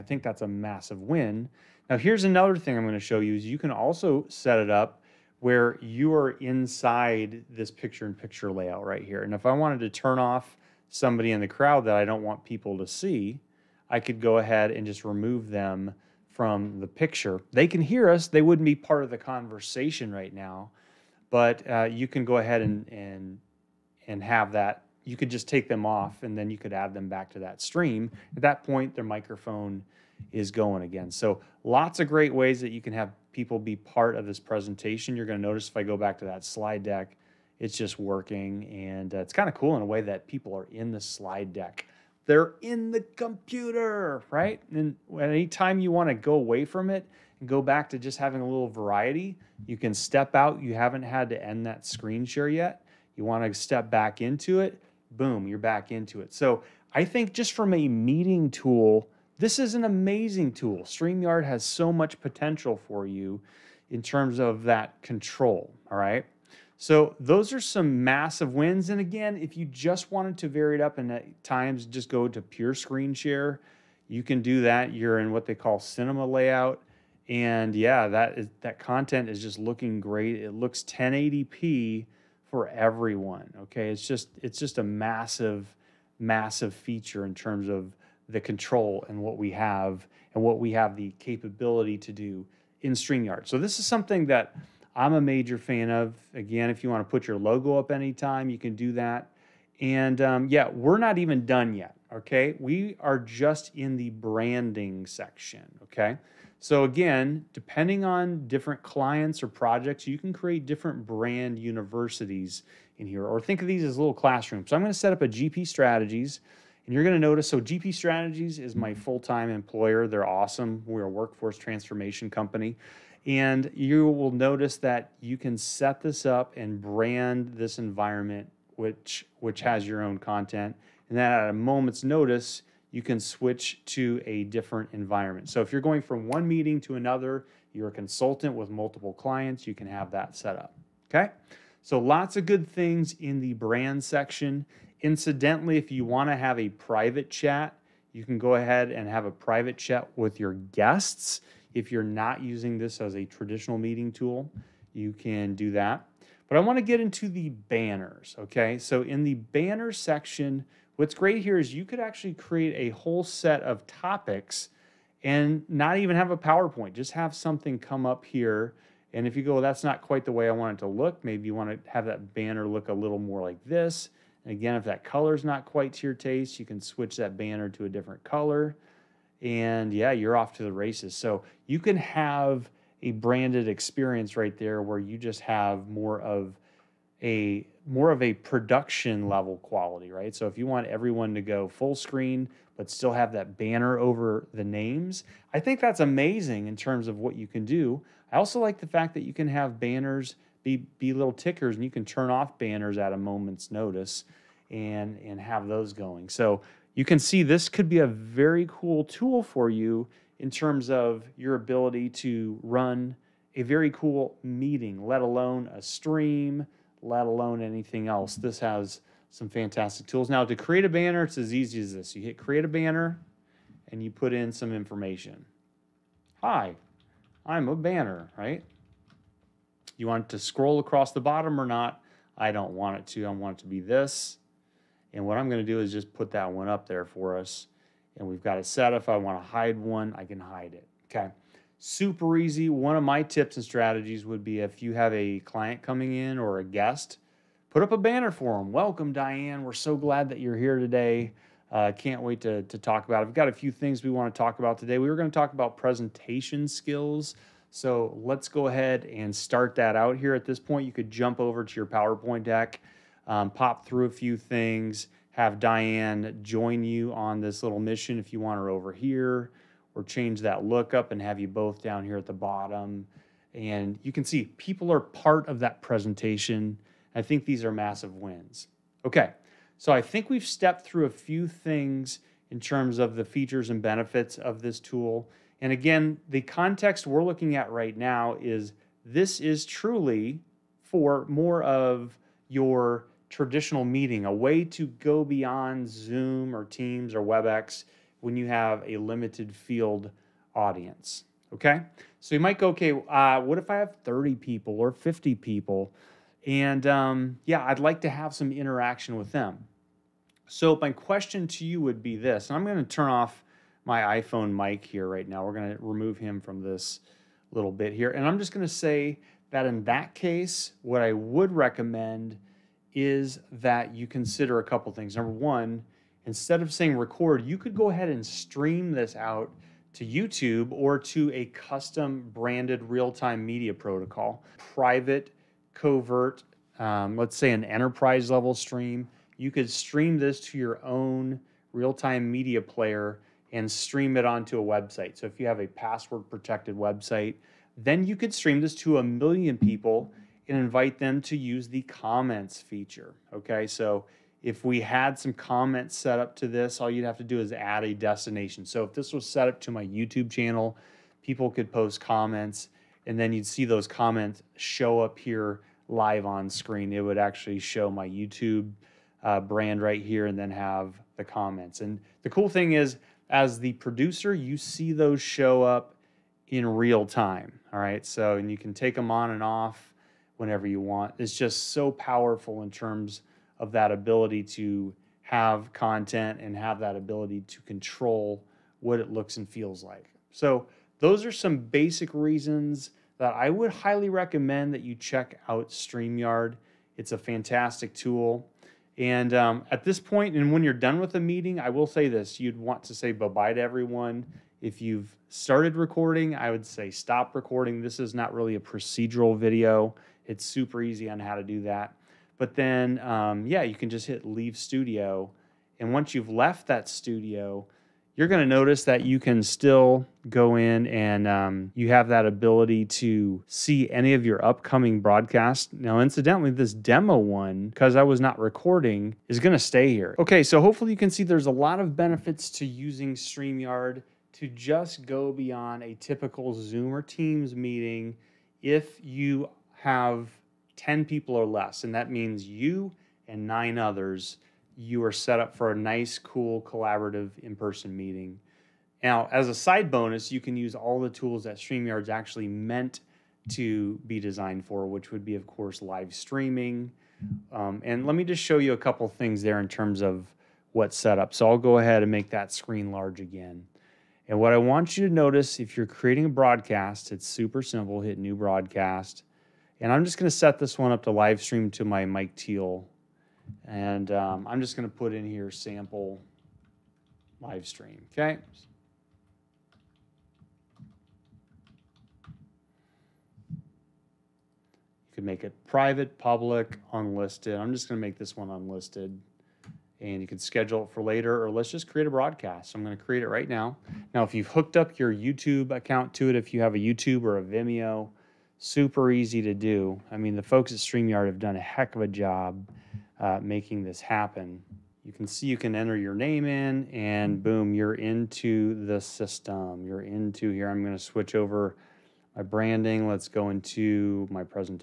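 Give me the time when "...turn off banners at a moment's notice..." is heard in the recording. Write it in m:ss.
3:22.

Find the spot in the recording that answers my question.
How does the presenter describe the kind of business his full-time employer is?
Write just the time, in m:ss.
2:01.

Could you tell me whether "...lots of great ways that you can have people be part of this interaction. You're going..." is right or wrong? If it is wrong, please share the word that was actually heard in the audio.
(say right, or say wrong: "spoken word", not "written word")
wrong: "presentation", not "interaction".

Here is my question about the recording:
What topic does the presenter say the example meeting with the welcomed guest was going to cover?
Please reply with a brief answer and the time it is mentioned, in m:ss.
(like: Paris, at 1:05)
presentation skills, at 4:15.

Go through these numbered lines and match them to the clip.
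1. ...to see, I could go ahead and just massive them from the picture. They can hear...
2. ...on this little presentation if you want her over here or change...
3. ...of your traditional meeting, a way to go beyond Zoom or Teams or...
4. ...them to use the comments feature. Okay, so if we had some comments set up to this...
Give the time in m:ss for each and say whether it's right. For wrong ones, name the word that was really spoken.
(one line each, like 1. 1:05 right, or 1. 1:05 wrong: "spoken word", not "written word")
1. 0:12 wrong: "remove", not "massive"
2. 4:27 wrong: "mission", not "presentation"
3. 4:51 right
4. 5:50 right.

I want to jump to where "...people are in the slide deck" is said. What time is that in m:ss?
0:40.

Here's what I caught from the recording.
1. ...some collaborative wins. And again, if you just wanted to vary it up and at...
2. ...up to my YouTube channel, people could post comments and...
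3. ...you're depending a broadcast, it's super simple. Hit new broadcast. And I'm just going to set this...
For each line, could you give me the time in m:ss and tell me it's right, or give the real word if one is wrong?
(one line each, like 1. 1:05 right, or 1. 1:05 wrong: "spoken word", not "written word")
1. 1:07 wrong: "massive", not "collaborative"
2. 5:59 right
3. 7:45 wrong: "creating", not "depending".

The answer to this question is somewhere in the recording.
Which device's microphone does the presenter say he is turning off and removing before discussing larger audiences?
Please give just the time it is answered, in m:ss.
5:14.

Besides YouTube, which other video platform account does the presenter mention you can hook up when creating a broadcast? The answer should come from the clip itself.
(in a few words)
Vimeo.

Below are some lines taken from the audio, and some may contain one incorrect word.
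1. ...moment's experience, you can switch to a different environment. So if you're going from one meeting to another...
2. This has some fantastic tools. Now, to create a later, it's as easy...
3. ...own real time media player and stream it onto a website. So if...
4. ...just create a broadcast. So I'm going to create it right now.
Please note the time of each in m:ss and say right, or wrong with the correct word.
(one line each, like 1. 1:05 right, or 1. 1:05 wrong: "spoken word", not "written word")
1. 2:11 wrong: "notice", not "experience"
2. 3:38 wrong: "banner", not "later"
3. 5:40 right
4. 8:11 right.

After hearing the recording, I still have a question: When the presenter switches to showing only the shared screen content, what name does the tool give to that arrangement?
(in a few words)
cinema layout.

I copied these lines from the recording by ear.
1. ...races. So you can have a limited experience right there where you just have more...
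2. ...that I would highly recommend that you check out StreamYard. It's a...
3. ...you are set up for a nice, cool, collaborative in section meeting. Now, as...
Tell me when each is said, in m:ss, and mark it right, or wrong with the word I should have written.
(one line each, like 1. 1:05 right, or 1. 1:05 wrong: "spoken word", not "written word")
1. 3:00 wrong: "branded", not "limited"
2. 6:33 right
3. 7:24 wrong: "person", not "section".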